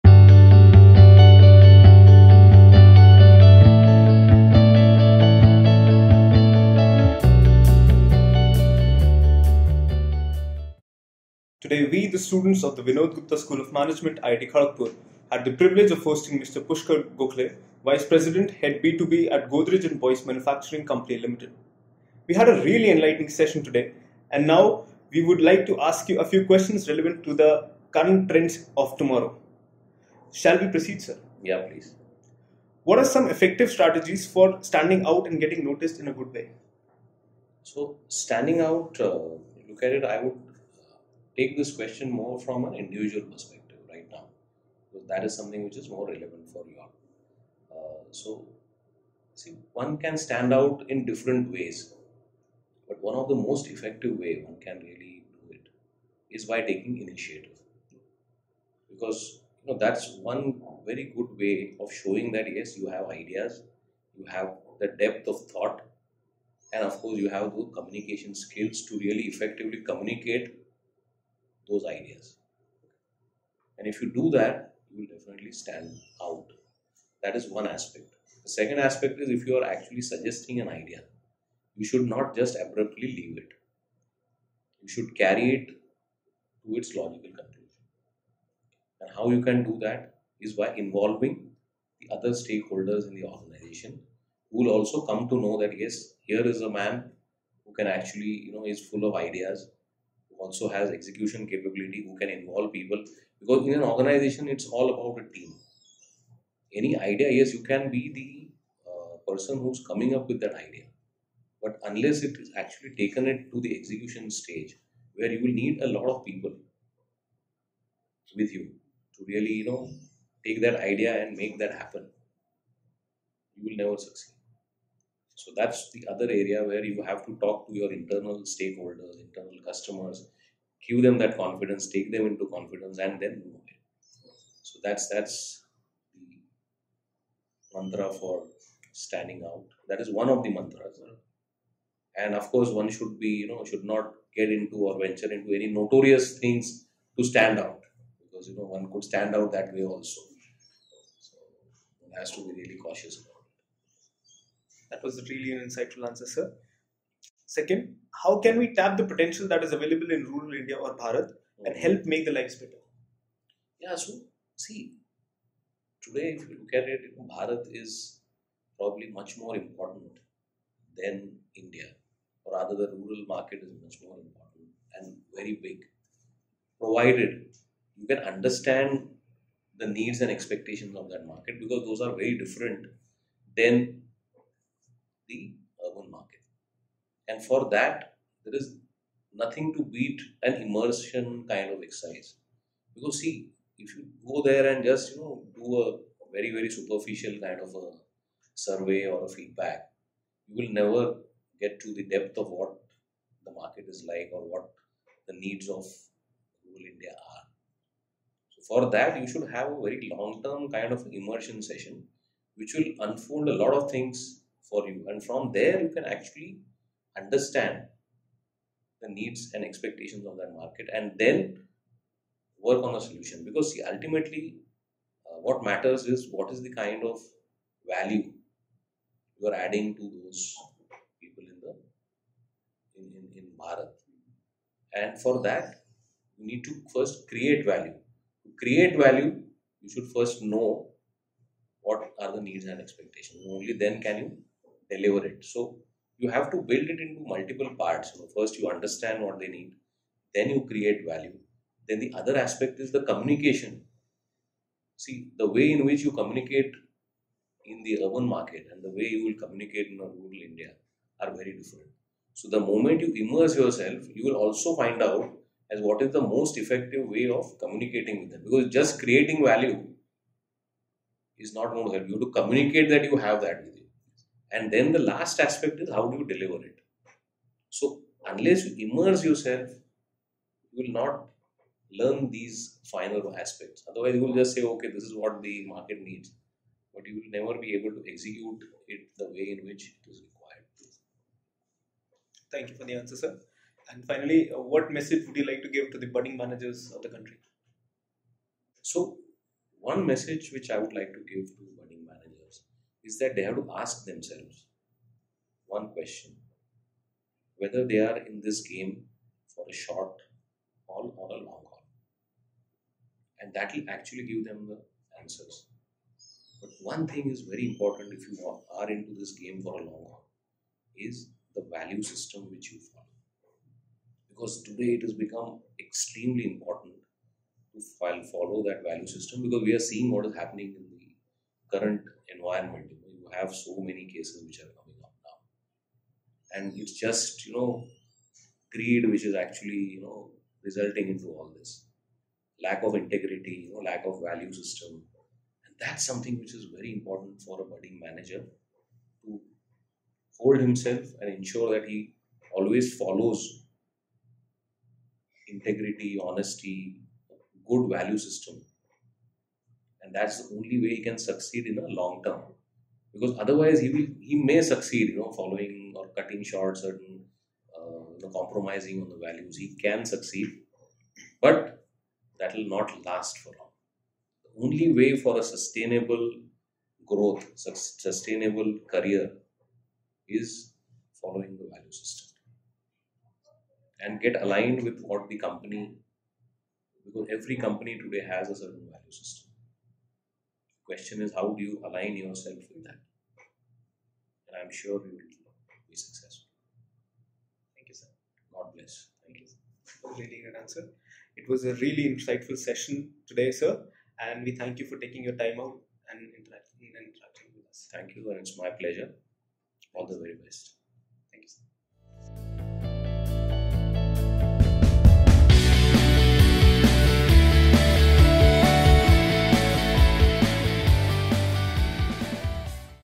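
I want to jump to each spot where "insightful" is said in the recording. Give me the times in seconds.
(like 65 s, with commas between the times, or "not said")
155 s, 402 s.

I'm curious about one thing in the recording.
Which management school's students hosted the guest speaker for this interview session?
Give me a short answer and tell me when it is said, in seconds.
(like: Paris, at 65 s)
Vinod Gupta School of Management, at 12 s.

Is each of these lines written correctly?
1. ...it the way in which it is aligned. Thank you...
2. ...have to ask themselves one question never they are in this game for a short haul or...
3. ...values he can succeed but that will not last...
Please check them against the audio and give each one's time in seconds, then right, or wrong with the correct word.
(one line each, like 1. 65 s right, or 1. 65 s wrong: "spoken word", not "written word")
1. 288 s wrong: "required", not "aligned"
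2. 303 s wrong: "whether", not "never"
3. 369 s right.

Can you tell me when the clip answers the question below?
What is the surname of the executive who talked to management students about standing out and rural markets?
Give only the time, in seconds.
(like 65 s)
17 s.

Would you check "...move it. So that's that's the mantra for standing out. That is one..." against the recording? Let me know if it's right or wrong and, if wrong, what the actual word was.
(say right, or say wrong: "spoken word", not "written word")
right.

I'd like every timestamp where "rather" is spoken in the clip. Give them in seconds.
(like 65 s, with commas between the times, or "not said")
172 s.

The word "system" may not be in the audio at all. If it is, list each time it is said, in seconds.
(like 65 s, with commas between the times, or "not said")
322 s, 329 s, 344 s, 358 s, 381 s, 389 s.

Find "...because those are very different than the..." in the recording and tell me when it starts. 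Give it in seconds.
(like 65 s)
181 s.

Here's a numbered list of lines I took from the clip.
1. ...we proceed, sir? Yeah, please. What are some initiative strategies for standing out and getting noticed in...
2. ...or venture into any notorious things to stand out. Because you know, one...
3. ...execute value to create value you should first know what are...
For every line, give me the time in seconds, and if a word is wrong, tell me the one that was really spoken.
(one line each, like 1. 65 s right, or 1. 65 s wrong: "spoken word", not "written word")
1. 30 s wrong: "effective", not "initiative"
2. 144 s right
3. 237 s wrong: "create", not "execute".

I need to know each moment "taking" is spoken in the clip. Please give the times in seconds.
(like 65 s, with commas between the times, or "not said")
56 s, 404 s.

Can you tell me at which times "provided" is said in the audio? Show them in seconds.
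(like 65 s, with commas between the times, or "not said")
176 s.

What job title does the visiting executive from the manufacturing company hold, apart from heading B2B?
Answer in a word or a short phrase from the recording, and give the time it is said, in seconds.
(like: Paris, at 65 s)
Vice President, at 17 s.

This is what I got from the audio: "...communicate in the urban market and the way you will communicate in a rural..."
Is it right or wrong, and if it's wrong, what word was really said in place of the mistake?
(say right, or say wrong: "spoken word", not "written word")
right.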